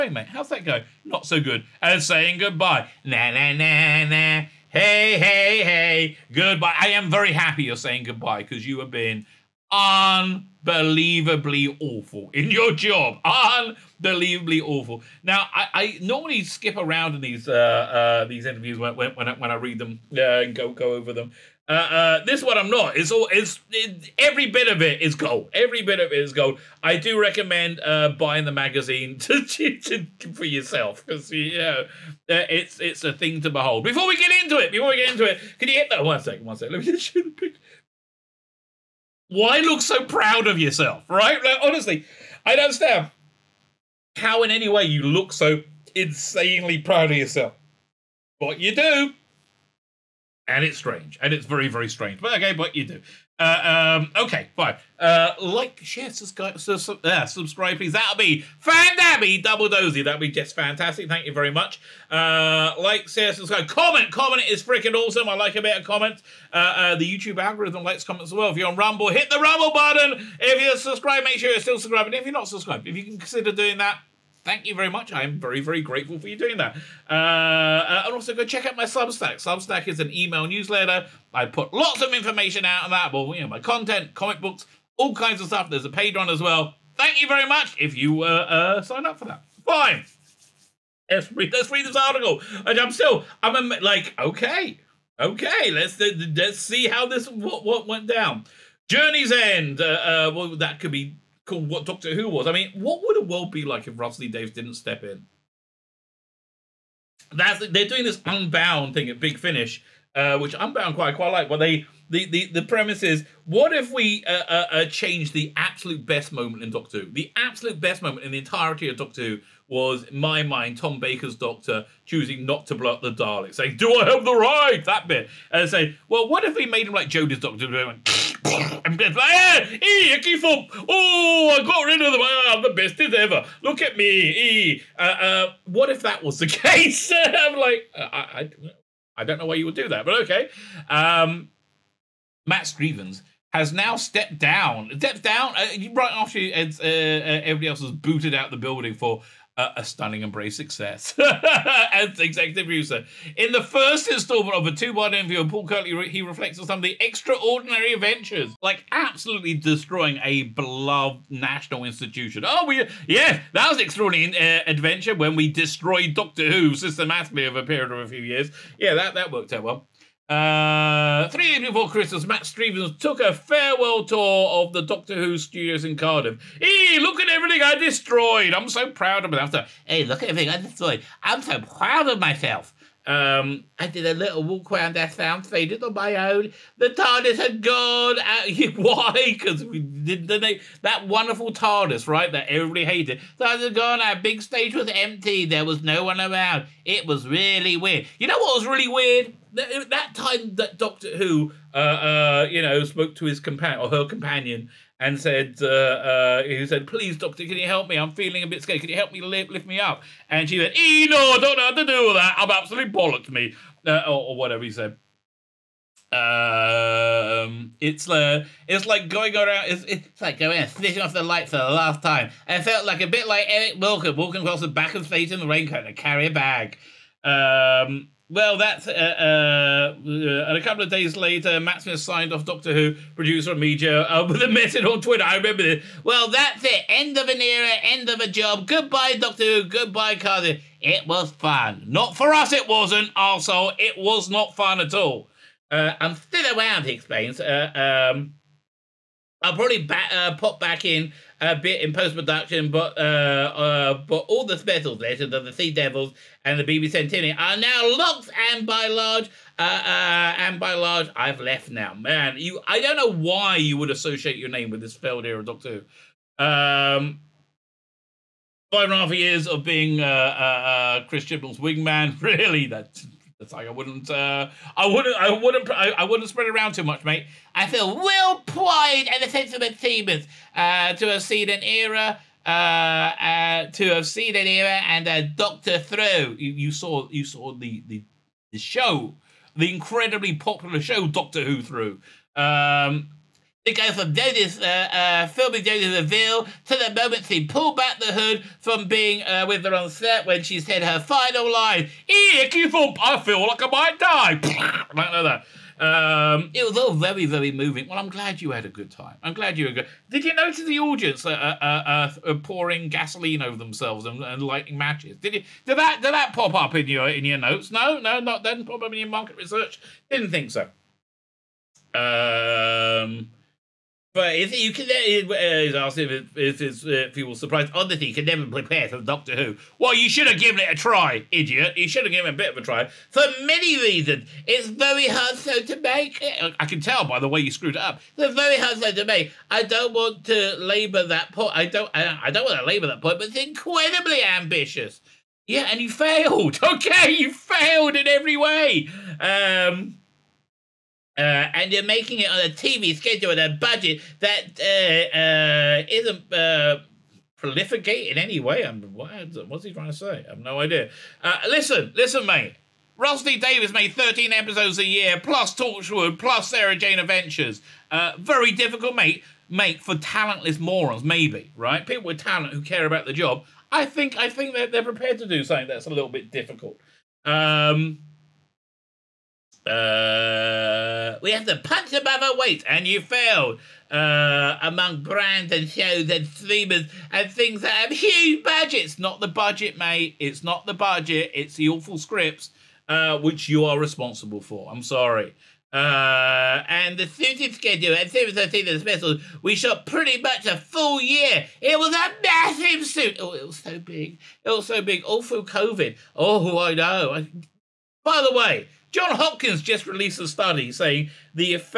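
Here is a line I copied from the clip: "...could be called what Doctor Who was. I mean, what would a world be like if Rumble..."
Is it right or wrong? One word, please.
wrong.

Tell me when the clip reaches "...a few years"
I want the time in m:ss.
2:47.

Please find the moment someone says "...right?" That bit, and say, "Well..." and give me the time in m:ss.
2:04.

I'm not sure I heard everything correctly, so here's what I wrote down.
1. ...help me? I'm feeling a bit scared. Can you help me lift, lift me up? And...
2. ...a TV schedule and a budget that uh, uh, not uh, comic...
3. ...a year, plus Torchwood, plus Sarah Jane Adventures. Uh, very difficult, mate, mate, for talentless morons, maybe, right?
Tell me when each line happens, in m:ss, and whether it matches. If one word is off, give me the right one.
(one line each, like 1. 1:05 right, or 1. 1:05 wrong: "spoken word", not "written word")
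1. 3:27 right
2. 5:52 wrong: "prolific", not "comic"
3. 6:04 right.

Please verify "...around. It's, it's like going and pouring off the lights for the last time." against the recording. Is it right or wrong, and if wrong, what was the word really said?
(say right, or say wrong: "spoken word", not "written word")
wrong: "switching", not "pouring".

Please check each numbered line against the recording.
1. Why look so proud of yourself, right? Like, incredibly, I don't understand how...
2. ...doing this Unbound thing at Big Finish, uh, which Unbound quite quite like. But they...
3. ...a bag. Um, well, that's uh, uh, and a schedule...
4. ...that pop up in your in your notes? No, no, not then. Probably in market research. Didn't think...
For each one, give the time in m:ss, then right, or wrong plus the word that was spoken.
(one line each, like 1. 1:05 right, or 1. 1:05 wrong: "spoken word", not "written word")
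1. 0:39 wrong: "honestly", not "incredibly"
2. 1:47 right
3. 3:46 wrong: "couple", not "schedule"
4. 5:16 right.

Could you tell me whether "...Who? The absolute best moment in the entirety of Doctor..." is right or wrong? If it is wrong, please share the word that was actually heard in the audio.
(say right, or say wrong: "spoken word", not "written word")
right.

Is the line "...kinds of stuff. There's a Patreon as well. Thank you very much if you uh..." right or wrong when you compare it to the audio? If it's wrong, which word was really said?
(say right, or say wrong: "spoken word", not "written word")
right.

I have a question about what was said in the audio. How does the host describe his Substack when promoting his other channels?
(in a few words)
email newsletter.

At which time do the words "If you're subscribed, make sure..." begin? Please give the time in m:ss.
1:10.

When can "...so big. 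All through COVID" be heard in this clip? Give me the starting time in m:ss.
6:44.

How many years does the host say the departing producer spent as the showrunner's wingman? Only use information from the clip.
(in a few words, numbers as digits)
5 and a half.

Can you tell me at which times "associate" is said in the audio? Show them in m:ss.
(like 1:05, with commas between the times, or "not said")
4:23.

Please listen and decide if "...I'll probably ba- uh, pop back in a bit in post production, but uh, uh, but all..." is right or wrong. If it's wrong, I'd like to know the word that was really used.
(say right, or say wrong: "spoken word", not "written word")
right.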